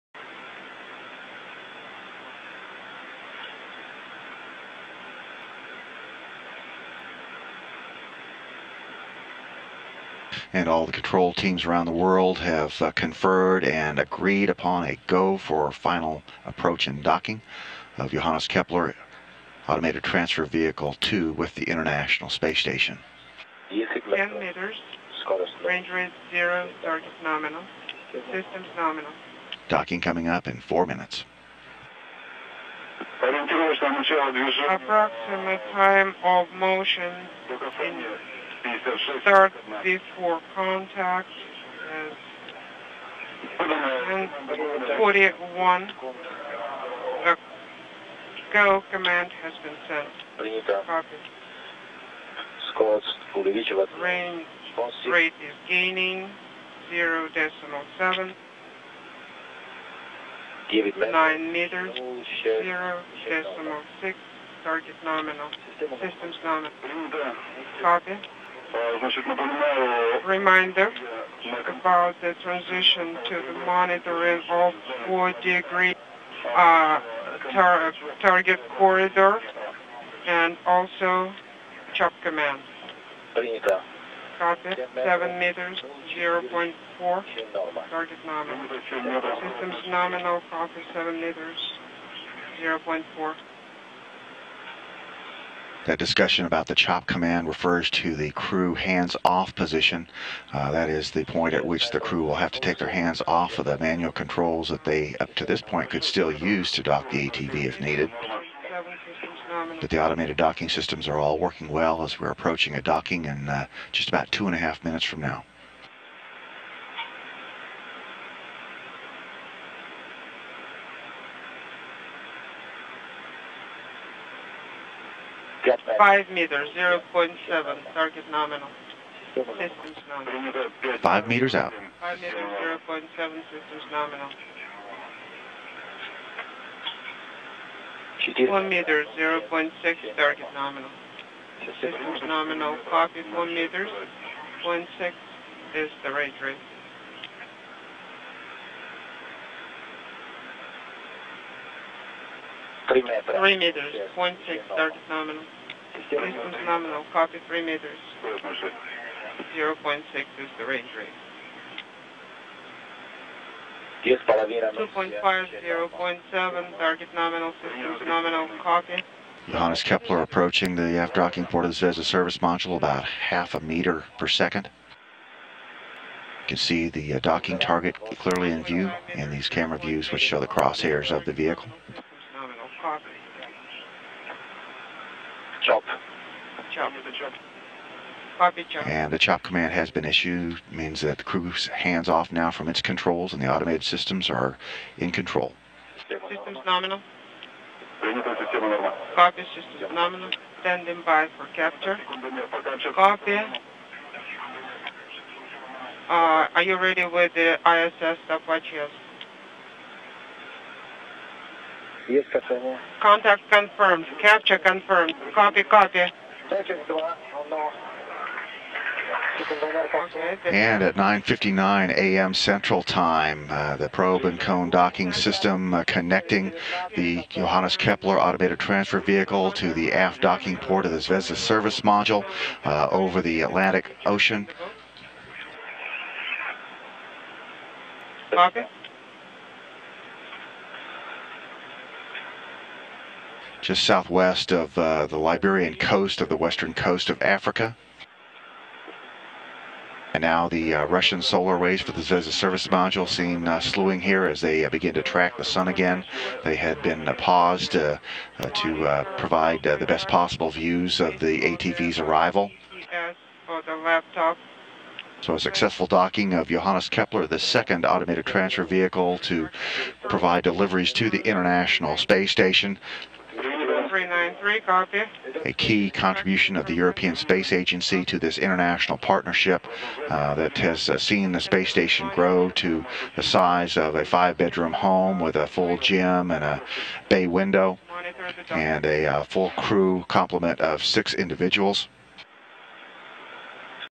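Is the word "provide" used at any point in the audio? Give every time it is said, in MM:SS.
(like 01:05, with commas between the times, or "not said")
04:19, 04:30.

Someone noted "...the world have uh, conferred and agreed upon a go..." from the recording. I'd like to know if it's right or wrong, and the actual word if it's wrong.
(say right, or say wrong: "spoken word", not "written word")
right.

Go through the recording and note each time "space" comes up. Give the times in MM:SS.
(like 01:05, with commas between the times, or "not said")
00:22, 04:31, 04:37, 04:41.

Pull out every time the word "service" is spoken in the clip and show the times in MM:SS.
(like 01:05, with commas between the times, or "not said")
02:52, 03:51, 04:12.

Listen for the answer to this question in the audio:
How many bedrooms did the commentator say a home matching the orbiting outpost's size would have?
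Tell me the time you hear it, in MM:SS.
04:44.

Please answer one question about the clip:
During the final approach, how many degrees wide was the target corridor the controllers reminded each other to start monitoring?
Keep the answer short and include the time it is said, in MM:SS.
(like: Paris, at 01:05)
4 degrees, at 01:15.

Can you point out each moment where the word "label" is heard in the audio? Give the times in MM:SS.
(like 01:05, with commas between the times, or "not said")
not said.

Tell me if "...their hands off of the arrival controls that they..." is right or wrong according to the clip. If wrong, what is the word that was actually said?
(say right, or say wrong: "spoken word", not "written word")
wrong: "manual", not "arrival".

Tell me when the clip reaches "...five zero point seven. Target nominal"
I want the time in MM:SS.
02:45.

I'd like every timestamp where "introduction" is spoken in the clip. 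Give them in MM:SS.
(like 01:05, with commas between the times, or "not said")
not said.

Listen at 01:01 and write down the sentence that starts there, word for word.
9 meters, 0 decimal 6, target nominal, systems nominal.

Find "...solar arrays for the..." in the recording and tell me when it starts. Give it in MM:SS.
04:11.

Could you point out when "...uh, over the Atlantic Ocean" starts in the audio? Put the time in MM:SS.
03:52.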